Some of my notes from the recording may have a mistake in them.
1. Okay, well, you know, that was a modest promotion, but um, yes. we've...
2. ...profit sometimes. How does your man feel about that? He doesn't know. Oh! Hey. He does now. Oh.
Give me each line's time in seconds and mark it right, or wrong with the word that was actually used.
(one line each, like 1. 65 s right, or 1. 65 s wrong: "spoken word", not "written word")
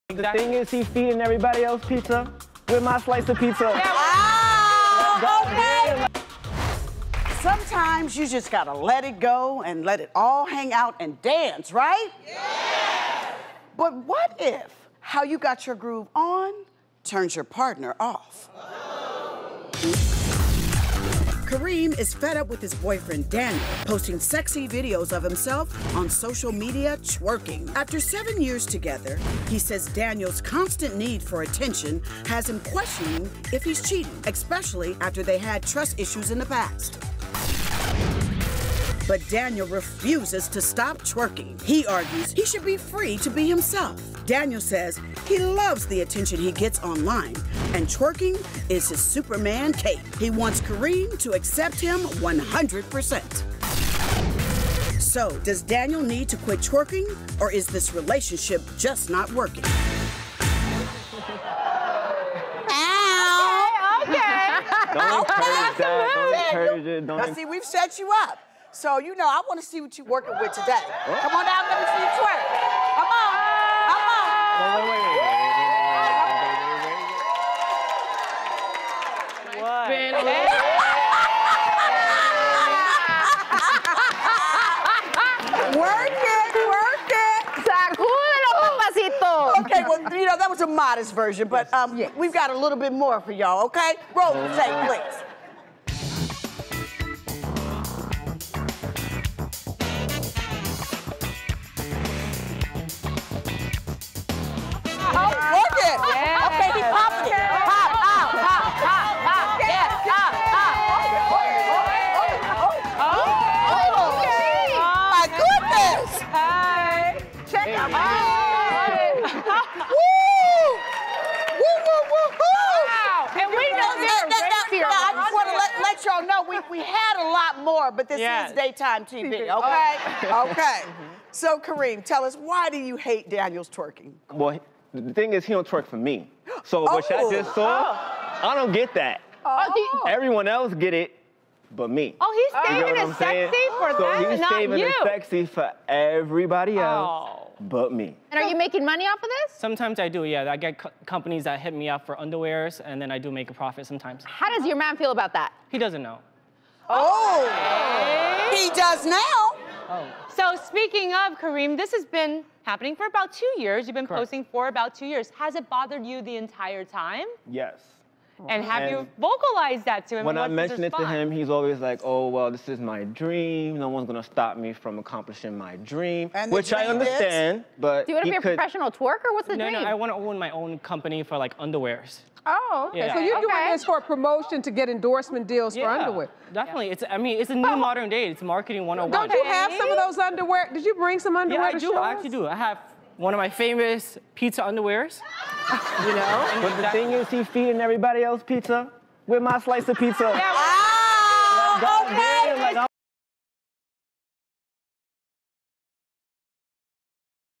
1. 89 s wrong: "version", not "promotion"
2. 153 s right.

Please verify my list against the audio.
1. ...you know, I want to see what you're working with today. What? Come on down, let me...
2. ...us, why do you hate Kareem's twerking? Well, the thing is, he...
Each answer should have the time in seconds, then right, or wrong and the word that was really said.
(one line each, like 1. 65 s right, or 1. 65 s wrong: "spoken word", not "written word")
1. 68 s right
2. 132 s wrong: "Daniel", not "Kareem".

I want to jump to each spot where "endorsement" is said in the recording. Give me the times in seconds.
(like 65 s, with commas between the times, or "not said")
184 s.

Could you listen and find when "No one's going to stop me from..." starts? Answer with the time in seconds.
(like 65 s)
173 s.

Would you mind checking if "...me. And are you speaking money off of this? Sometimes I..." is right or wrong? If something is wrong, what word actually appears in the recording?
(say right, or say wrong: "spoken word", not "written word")
wrong: "making", not "speaking".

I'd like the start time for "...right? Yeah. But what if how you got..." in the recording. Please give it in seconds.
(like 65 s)
11 s.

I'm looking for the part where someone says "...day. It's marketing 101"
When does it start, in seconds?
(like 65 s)
188 s.